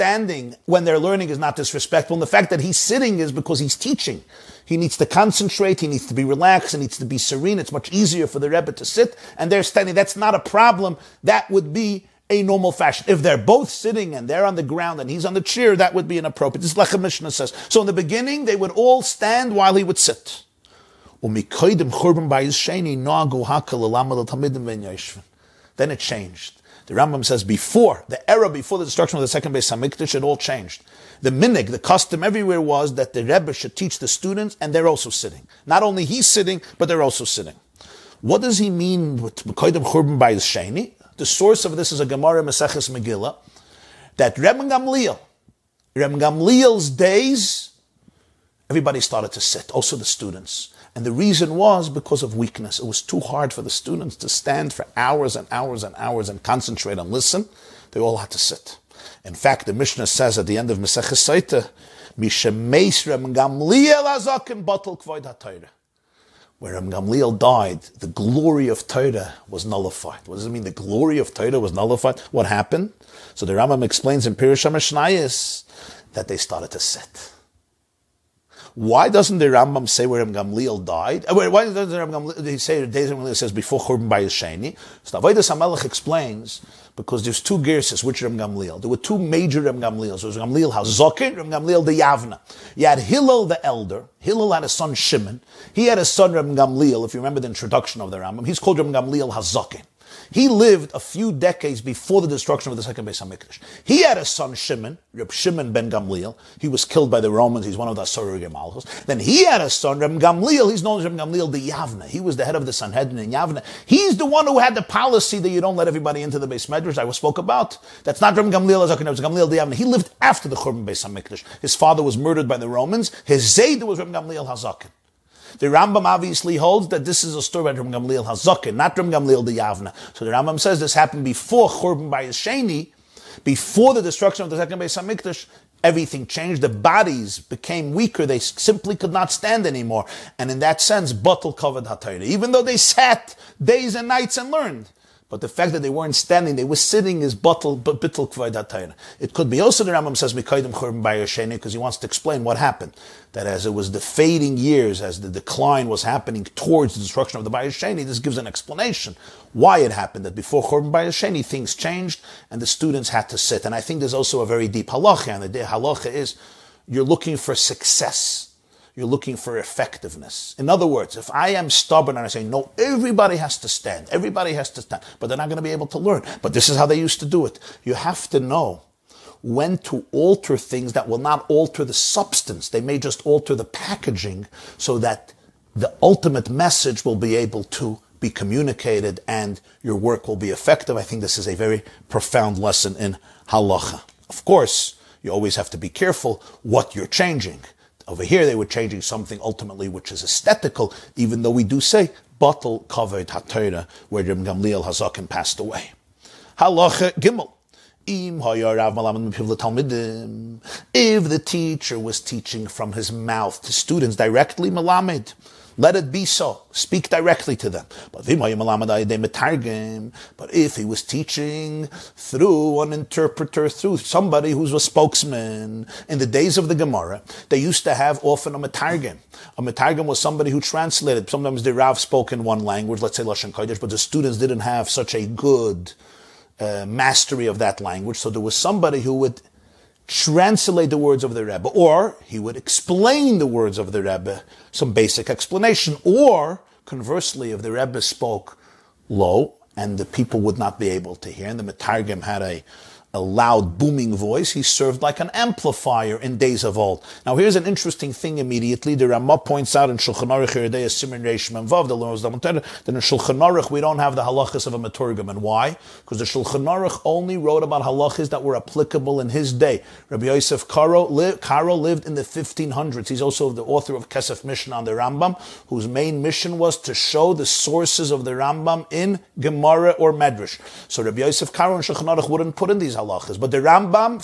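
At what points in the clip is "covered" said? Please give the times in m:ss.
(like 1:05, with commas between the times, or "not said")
2:21, 3:22.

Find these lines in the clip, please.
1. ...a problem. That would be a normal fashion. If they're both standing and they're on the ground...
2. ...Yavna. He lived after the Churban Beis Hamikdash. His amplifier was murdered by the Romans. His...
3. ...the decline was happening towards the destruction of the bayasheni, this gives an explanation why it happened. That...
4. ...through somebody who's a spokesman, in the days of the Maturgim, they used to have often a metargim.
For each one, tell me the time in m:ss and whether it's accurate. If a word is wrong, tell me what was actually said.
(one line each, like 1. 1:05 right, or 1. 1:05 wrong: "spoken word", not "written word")
1. 0:10 wrong: "sitting", not "standing"
2. 1:59 wrong: "father", not "amplifier"
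3. 2:35 right
4. 3:43 wrong: "Gemara", not "Maturgim".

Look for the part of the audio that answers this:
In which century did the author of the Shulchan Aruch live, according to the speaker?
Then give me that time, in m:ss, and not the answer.
4:32.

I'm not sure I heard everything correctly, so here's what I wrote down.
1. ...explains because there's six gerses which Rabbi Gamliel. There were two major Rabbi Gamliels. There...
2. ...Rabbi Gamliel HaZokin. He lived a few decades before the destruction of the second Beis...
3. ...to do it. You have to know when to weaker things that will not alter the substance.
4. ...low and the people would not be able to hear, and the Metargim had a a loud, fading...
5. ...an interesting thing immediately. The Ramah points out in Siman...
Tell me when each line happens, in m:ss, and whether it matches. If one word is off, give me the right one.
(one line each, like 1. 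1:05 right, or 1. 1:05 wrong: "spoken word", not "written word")
1. 1:25 wrong: "two", not "six"
2. 1:38 right
3. 2:57 wrong: "alter", not "weaker"
4. 4:09 wrong: "booming", not "fading"
5. 4:17 wrong: "Shulchan", not "Siman".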